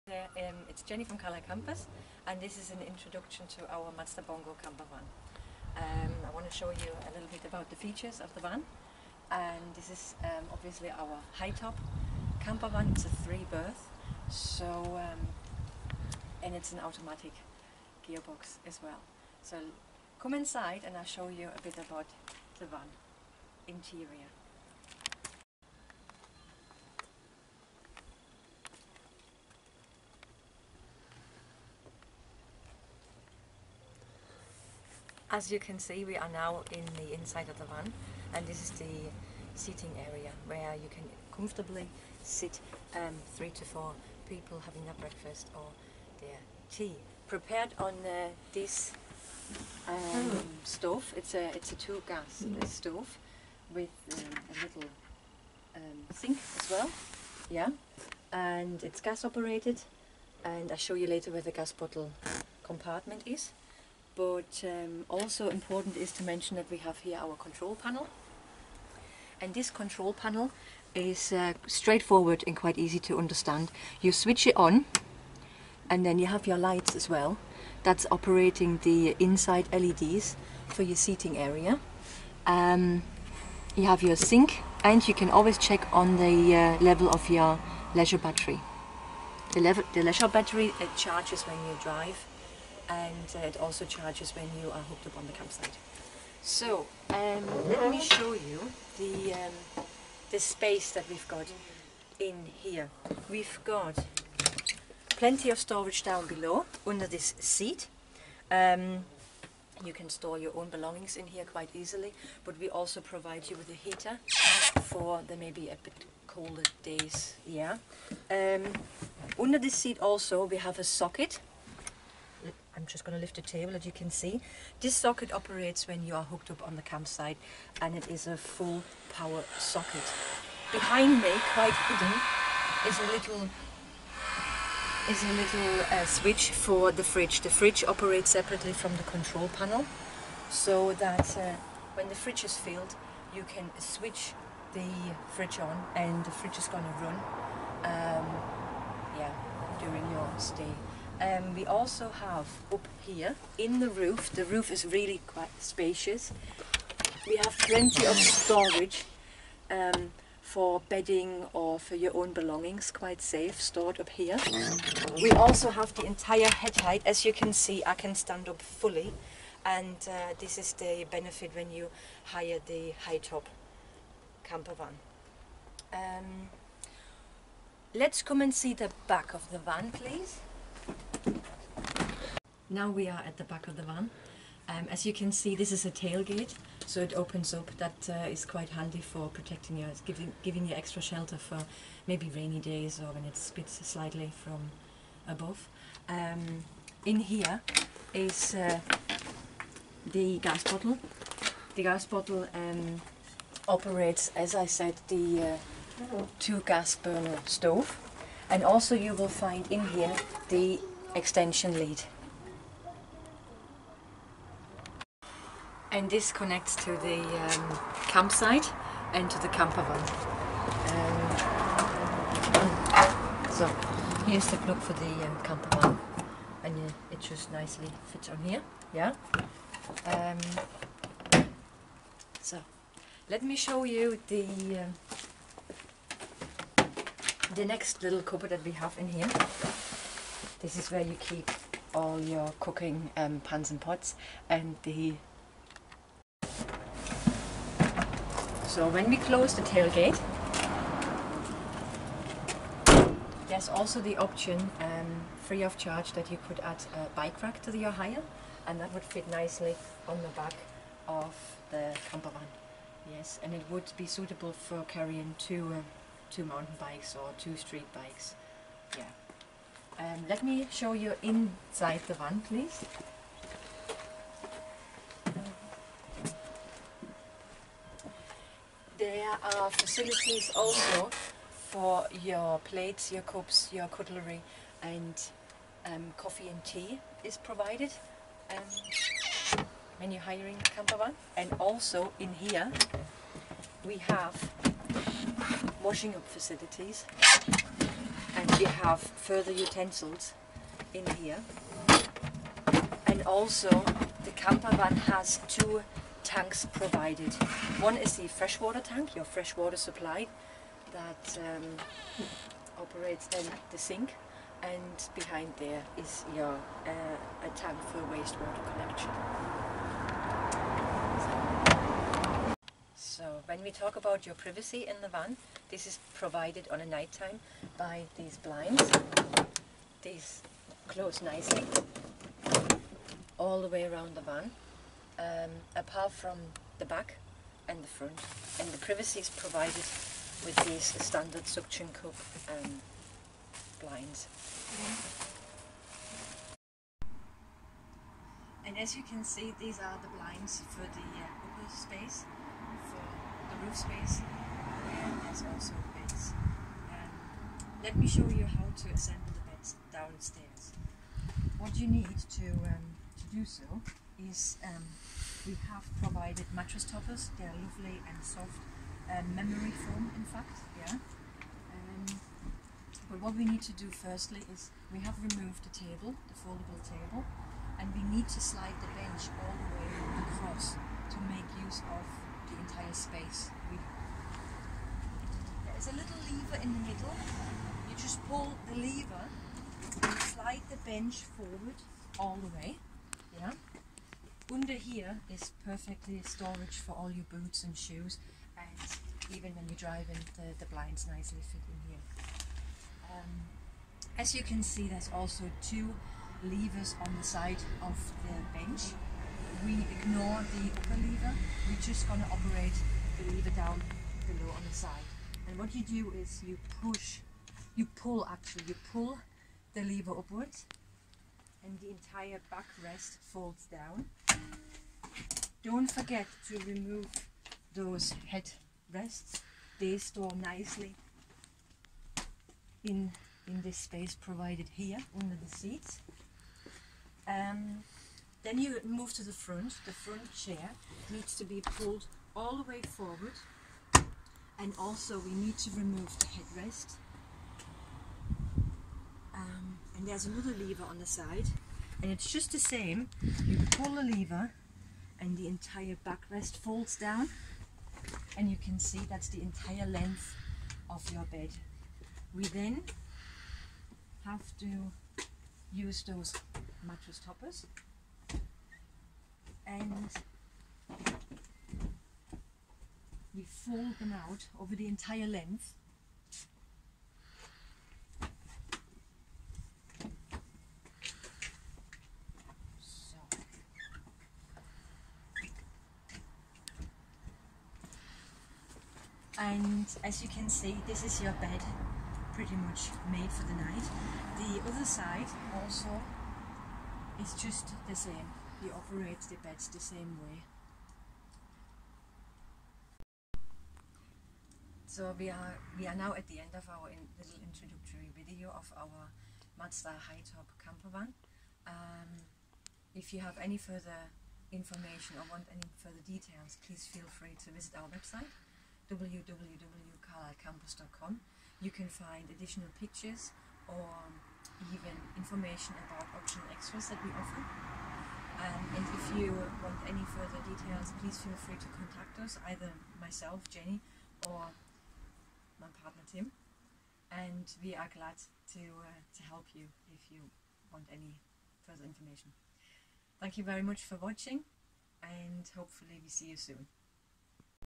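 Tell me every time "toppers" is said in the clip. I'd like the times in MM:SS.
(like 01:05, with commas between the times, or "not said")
06:06, 07:47.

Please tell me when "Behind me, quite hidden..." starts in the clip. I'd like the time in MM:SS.
02:10.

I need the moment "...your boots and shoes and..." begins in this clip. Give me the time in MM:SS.
06:37.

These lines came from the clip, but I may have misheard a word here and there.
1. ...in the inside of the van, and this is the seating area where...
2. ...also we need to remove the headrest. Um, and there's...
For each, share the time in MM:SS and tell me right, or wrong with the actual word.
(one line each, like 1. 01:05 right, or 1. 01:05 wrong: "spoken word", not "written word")
1. 00:36 right
2. 07:24 right.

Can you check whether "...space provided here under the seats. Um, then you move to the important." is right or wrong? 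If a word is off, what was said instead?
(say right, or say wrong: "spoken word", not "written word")
wrong: "front", not "important".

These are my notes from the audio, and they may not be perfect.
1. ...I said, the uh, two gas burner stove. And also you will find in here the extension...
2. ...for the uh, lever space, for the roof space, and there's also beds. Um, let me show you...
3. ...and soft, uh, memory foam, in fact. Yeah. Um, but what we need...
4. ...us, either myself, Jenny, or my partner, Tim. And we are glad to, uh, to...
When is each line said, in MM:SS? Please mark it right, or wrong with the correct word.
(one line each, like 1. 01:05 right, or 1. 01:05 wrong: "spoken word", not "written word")
1. 03:24 right
2. 05:50 wrong: "upper", not "lever"
3. 06:08 right
4. 08:52 right.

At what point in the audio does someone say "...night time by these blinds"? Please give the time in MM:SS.
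05:26.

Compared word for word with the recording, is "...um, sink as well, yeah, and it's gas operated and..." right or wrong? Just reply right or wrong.
right.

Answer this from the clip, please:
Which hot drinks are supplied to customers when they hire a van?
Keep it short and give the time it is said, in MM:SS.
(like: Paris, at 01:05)
Coffee and tea, at 04:46.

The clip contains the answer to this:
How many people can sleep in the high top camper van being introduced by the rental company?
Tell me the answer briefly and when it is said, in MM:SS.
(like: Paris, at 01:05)
3, at 00:13.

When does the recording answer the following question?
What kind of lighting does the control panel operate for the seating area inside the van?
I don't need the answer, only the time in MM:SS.
01:19.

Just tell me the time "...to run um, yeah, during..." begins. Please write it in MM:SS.
02:26.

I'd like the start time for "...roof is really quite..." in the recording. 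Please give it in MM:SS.
02:34.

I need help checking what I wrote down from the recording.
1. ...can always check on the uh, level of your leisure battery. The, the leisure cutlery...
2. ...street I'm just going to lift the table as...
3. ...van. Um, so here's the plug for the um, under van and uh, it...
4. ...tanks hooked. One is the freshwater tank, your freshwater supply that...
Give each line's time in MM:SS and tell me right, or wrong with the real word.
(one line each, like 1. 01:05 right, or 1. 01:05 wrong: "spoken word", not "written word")
1. 01:25 wrong: "battery", not "cutlery"
2. 02:00 wrong: "socket", not "street"
3. 03:39 wrong: "camper", not "under"
4. 05:06 wrong: "provided", not "hooked".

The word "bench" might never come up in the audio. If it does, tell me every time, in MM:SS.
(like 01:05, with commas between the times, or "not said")
06:18, 06:30, 06:48.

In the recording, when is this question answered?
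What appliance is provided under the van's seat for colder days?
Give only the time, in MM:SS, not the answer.
01:53.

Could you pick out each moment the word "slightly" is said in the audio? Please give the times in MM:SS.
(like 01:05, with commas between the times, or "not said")
03:13.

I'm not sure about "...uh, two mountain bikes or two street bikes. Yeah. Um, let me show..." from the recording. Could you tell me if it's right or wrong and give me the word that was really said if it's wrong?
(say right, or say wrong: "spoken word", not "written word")
right.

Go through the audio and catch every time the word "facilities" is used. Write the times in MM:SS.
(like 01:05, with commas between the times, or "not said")
04:39, 04:56.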